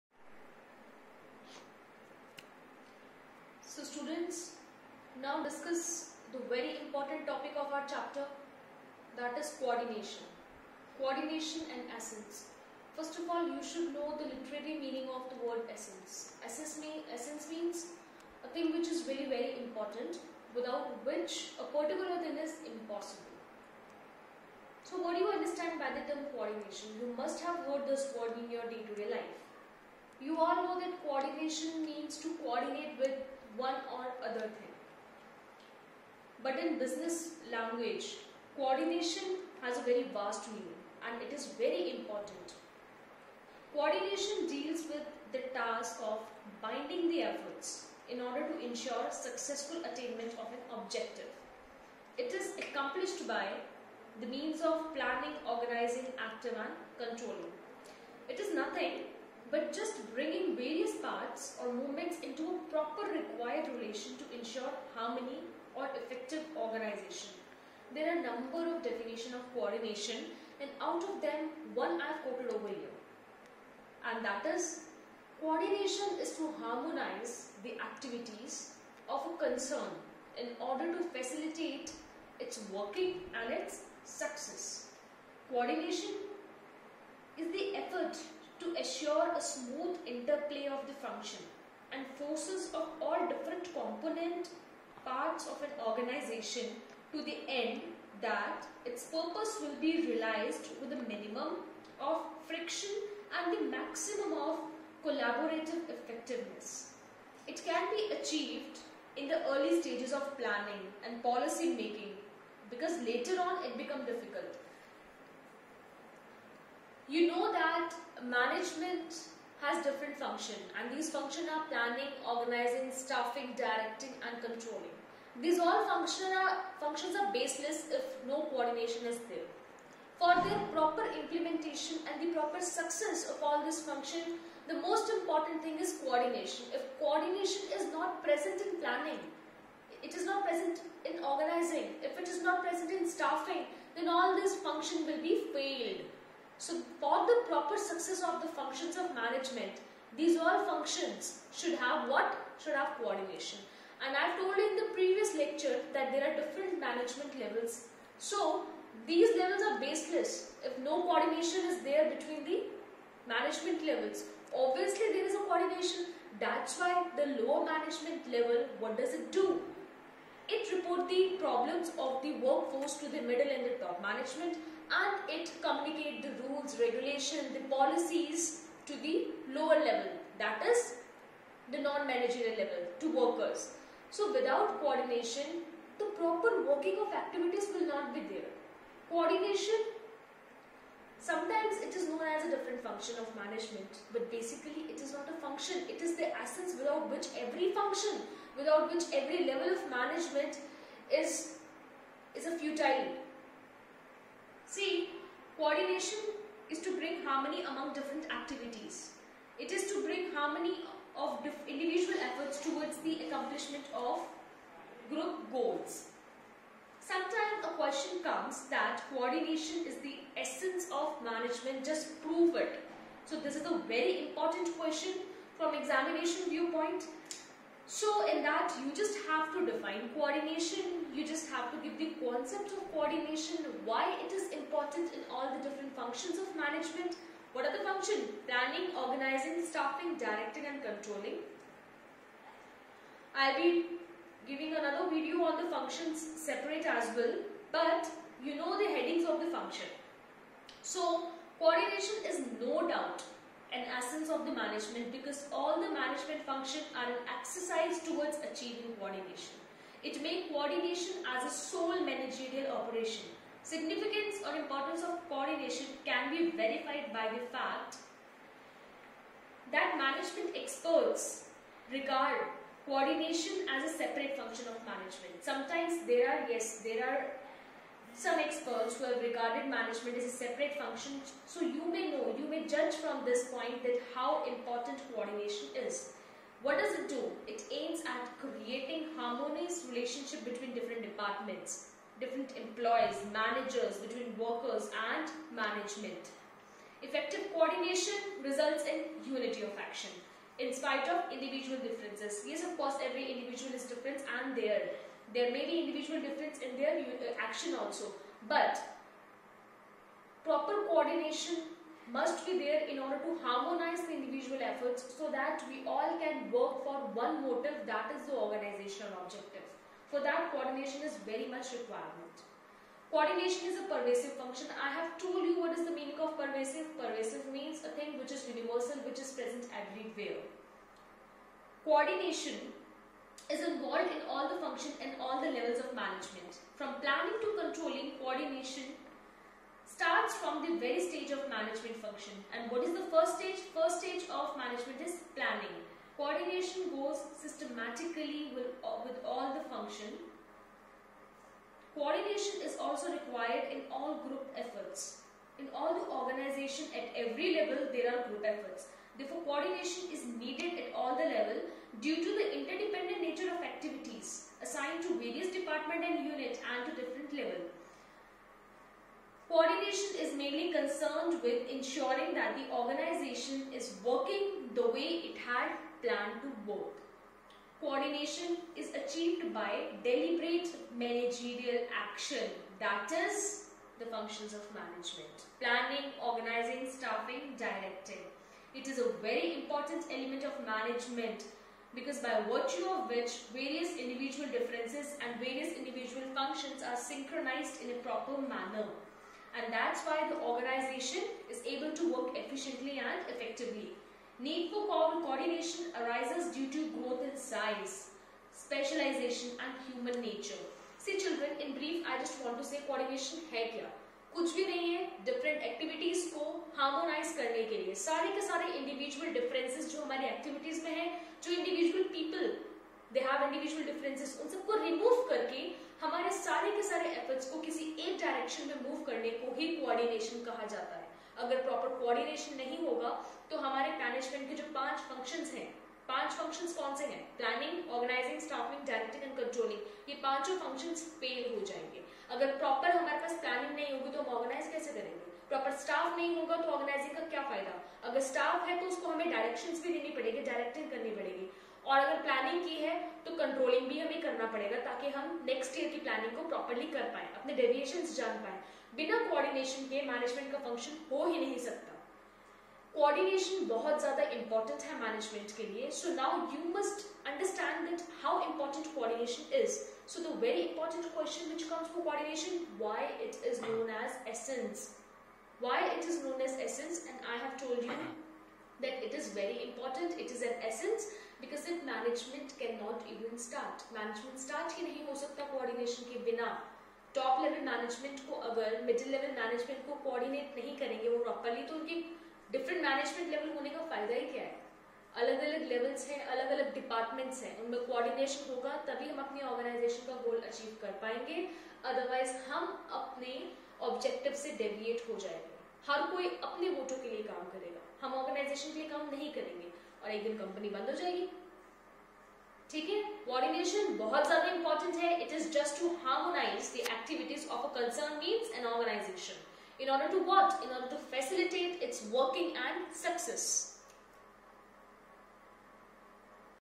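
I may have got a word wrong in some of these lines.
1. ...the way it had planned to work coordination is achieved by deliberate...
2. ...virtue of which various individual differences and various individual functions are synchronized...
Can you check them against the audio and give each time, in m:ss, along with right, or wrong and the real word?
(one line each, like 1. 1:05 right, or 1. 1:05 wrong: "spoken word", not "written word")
1. 6:14 right
2. 6:32 right.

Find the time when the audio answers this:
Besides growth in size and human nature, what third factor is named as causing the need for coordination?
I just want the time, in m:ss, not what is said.
6:48.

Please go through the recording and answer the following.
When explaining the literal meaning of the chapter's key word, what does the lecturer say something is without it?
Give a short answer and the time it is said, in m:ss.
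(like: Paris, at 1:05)
impossible, at 0:22.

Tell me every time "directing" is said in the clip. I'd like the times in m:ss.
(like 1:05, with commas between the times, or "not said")
2:03, 4:00, 6:27.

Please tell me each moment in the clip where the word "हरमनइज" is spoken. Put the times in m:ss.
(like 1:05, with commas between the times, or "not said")
6:56, 8:36.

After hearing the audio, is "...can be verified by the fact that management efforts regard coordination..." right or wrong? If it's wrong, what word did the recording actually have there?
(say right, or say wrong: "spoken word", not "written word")
wrong: "experts", not "efforts".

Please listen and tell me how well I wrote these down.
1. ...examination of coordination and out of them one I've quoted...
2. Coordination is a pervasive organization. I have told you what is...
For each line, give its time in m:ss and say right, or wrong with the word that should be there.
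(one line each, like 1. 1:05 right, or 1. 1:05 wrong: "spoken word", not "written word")
1. 1:08 wrong: "definition", not "examination"
2. 5:23 wrong: "function", not "organization".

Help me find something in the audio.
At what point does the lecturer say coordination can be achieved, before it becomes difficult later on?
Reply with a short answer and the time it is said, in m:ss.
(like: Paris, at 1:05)
early stages of planning, at 1:49.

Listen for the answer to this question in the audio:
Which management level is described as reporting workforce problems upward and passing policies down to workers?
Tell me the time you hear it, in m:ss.
2:47.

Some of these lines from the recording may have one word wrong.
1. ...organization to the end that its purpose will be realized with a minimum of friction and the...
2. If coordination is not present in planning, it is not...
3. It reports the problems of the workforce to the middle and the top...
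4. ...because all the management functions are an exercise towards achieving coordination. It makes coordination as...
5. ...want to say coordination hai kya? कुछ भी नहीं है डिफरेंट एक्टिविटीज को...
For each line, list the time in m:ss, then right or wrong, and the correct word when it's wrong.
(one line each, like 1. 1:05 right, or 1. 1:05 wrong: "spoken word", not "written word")
1. 1:35 right
2. 2:16 right
3. 2:50 right
4. 4:15 right
5. 6:52 right.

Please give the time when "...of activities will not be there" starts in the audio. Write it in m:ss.
3:06.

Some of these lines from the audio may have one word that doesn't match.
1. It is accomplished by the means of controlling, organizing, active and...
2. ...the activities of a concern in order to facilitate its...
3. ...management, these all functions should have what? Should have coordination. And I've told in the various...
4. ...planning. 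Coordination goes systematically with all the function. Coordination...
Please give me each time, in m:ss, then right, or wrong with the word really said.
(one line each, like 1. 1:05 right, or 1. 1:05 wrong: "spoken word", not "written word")
1. 0:52 wrong: "planning", not "controlling"
2. 1:17 right
3. 2:29 wrong: "previous", not "various"
4. 5:45 right.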